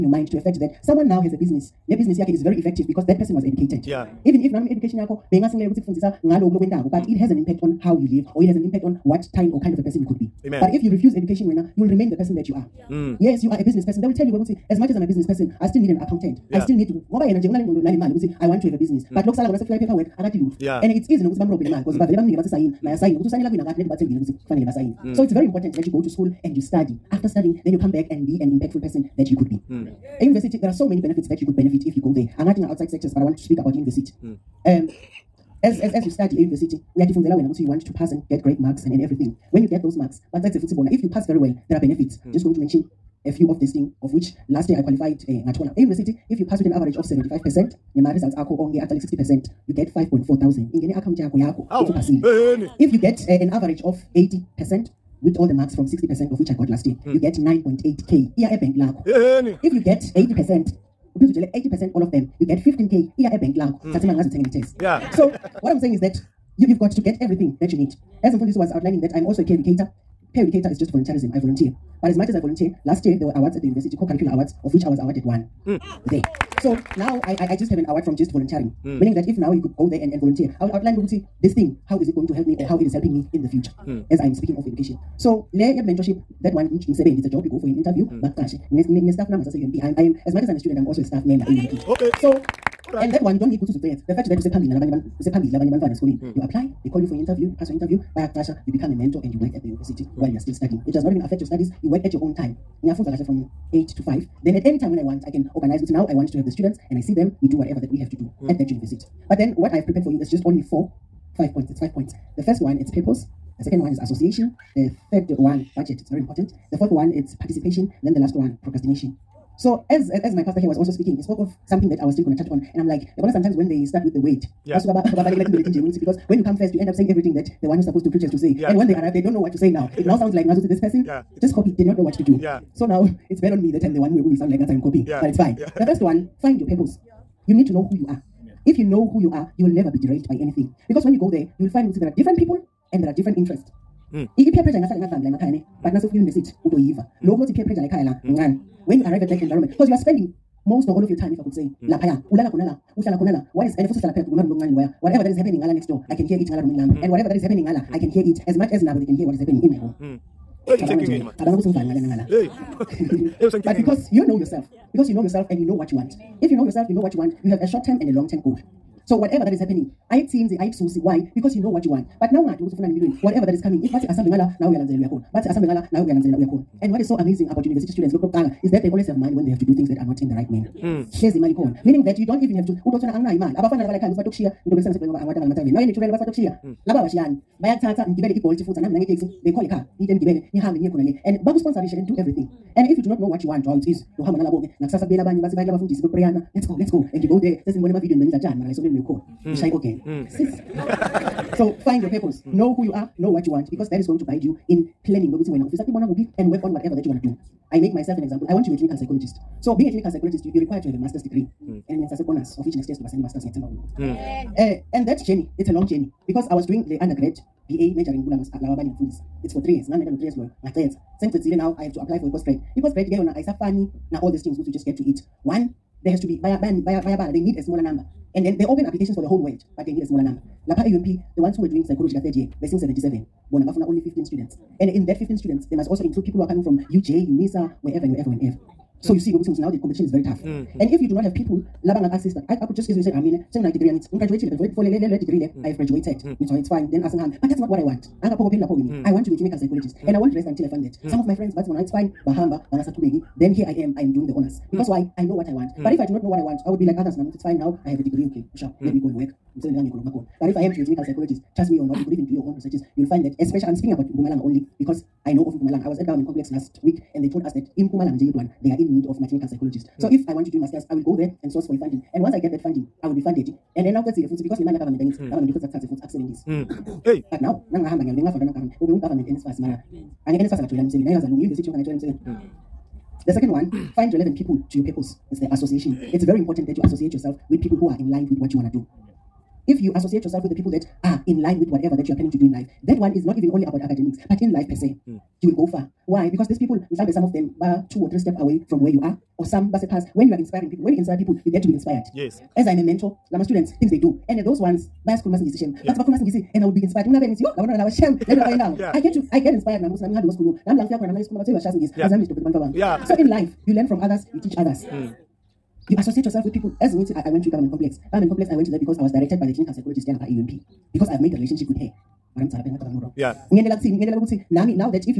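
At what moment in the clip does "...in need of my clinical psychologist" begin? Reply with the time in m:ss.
4:28.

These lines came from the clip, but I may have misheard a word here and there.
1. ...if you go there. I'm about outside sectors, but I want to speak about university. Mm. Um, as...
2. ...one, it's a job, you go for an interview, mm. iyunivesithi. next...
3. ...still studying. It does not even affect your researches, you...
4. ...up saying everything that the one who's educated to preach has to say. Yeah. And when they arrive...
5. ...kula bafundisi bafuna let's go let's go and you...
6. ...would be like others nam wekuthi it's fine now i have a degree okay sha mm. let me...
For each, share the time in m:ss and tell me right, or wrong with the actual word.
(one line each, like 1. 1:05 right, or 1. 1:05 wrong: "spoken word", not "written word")
1. 0:31 right
2. 1:26 wrong: "bakashi", not "iyunivesithi"
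3. 1:40 wrong: "studies", not "researches"
4. 2:06 wrong: "supposed", not "educated"
5. 3:15 wrong: "bekupreyana", not "bafuna"
6. 4:16 wrong: "ukuthi", not "wekuthi".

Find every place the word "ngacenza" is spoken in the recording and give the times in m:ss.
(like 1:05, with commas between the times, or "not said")
3:40.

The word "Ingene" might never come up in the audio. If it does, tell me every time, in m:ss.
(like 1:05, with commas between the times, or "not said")
0:50.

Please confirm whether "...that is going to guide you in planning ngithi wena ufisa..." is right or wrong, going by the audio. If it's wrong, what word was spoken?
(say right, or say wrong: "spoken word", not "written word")
wrong: "wekuthi", not "ngithi".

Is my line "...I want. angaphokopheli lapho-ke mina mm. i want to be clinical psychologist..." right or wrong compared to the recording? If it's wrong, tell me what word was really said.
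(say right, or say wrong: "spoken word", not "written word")
right.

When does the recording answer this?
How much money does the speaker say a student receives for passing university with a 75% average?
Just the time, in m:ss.
0:49.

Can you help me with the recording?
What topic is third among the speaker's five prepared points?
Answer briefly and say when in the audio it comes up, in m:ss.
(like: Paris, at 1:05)
Budget, at 1:55.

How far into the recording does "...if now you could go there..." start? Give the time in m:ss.
1:19.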